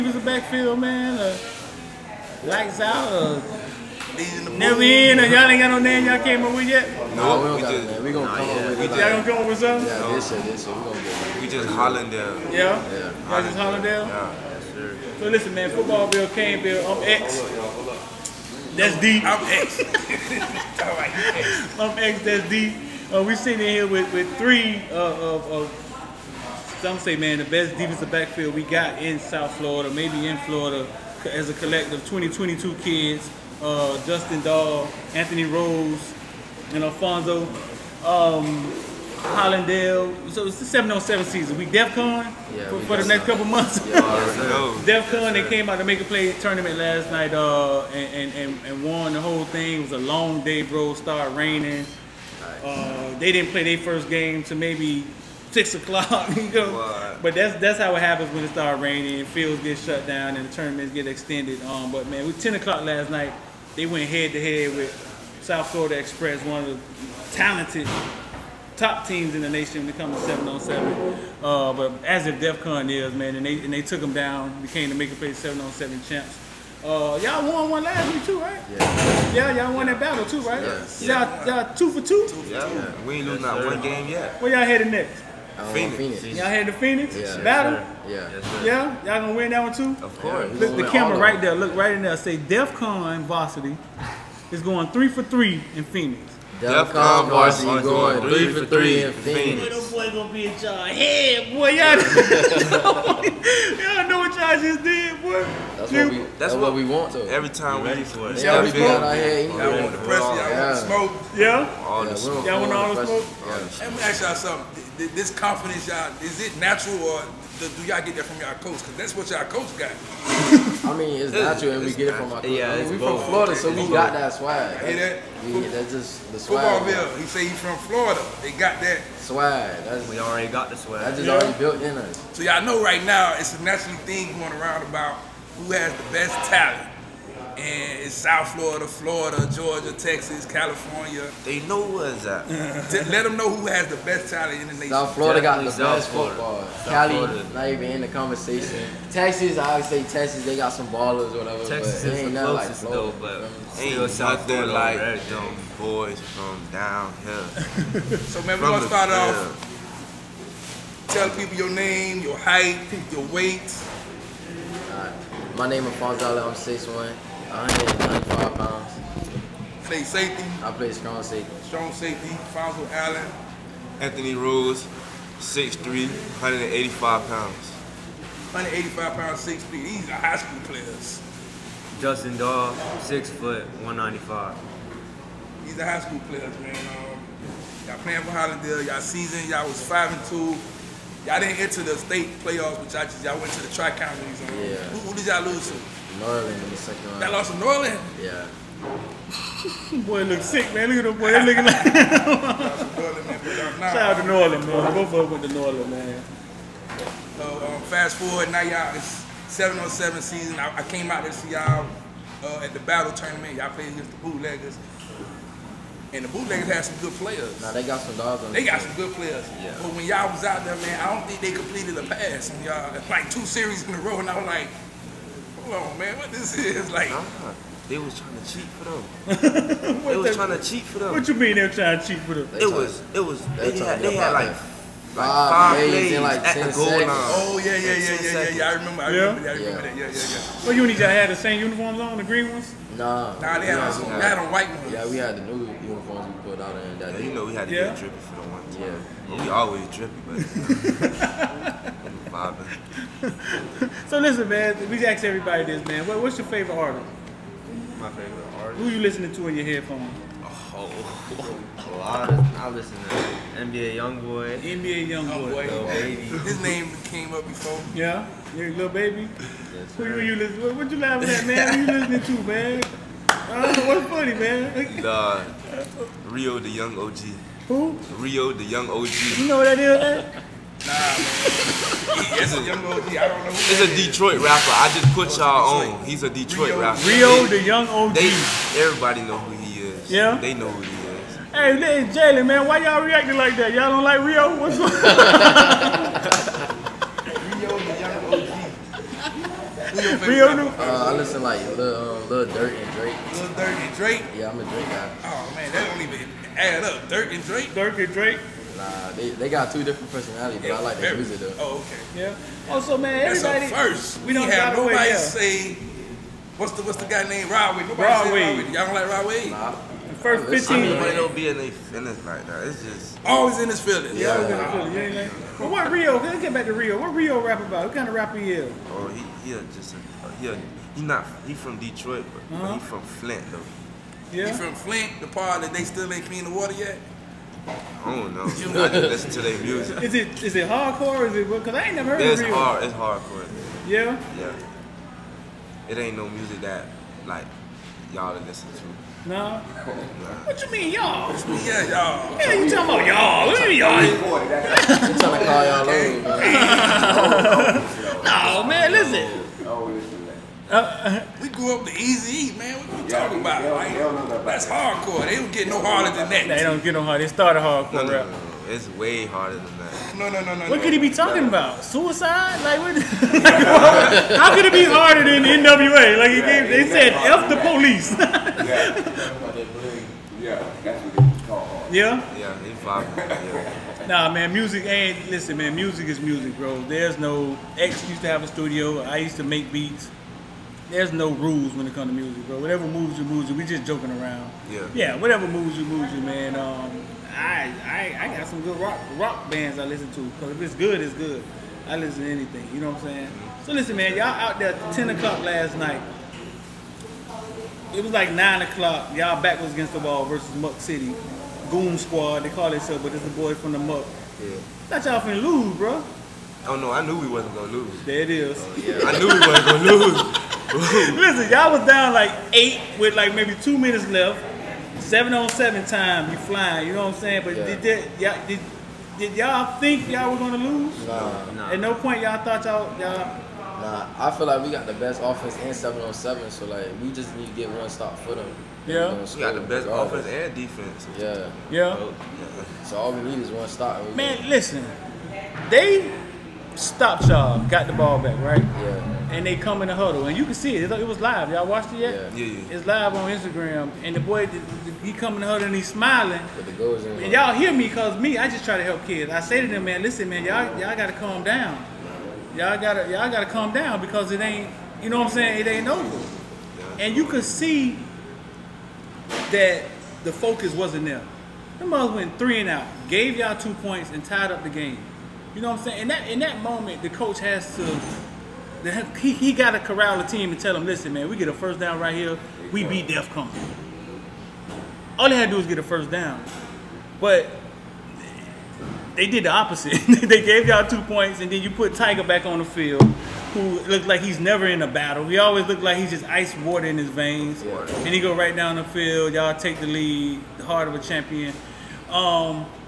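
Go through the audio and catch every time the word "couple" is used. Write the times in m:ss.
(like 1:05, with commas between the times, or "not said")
0:43.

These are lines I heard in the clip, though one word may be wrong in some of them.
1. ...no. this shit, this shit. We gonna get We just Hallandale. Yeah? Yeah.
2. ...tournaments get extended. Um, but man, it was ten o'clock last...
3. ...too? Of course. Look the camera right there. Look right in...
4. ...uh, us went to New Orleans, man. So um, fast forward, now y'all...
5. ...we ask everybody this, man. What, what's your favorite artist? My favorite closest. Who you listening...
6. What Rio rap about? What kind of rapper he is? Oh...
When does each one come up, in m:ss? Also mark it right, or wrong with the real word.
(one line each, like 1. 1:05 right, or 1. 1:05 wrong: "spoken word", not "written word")
1. 0:09 right
2. 1:00 right
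3. 1:29 right
4. 3:24 right
5. 4:14 wrong: "artist", not "closest"
6. 5:26 right.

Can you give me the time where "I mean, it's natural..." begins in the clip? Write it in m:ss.
2:00.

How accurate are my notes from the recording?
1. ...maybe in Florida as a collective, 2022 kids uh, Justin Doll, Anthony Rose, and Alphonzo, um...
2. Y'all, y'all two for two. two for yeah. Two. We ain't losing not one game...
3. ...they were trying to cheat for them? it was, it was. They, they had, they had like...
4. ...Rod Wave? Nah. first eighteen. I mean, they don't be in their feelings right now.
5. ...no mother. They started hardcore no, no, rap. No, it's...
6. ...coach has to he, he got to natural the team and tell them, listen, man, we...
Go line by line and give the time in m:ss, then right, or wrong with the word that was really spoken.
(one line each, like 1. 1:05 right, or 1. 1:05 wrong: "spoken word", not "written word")
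1. 0:29 right
2. 1:21 right
3. 3:51 right
4. 5:19 wrong: "fifteen", not "eighteen"
5. 6:06 wrong: "harder", not "mother"
6. 7:57 wrong: "corral", not "natural".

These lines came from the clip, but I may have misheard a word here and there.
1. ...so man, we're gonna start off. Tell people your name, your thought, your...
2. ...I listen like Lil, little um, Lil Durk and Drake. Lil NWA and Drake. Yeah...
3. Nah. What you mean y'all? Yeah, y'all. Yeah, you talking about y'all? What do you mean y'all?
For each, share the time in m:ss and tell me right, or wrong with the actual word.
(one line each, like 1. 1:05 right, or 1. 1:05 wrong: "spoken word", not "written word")
1. 2:38 wrong: "height", not "thought"
2. 5:00 wrong: "Durk", not "NWA"
3. 5:49 right.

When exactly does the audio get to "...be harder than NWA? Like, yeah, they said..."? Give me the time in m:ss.
6:14.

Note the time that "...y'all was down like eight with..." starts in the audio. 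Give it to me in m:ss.
7:01.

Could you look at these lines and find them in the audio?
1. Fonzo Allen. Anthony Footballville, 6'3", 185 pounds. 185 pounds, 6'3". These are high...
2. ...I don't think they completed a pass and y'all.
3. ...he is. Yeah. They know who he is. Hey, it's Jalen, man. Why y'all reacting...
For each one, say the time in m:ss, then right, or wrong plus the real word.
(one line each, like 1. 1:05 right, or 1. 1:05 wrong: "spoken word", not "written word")
1. 2:52 wrong: "Rose", not "Footballville"
2. 3:40 right
3. 4:49 right.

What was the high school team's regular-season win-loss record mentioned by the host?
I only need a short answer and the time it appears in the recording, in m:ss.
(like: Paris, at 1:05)
5 and 2, at 3:09.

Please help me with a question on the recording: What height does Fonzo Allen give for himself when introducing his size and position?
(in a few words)
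6'1".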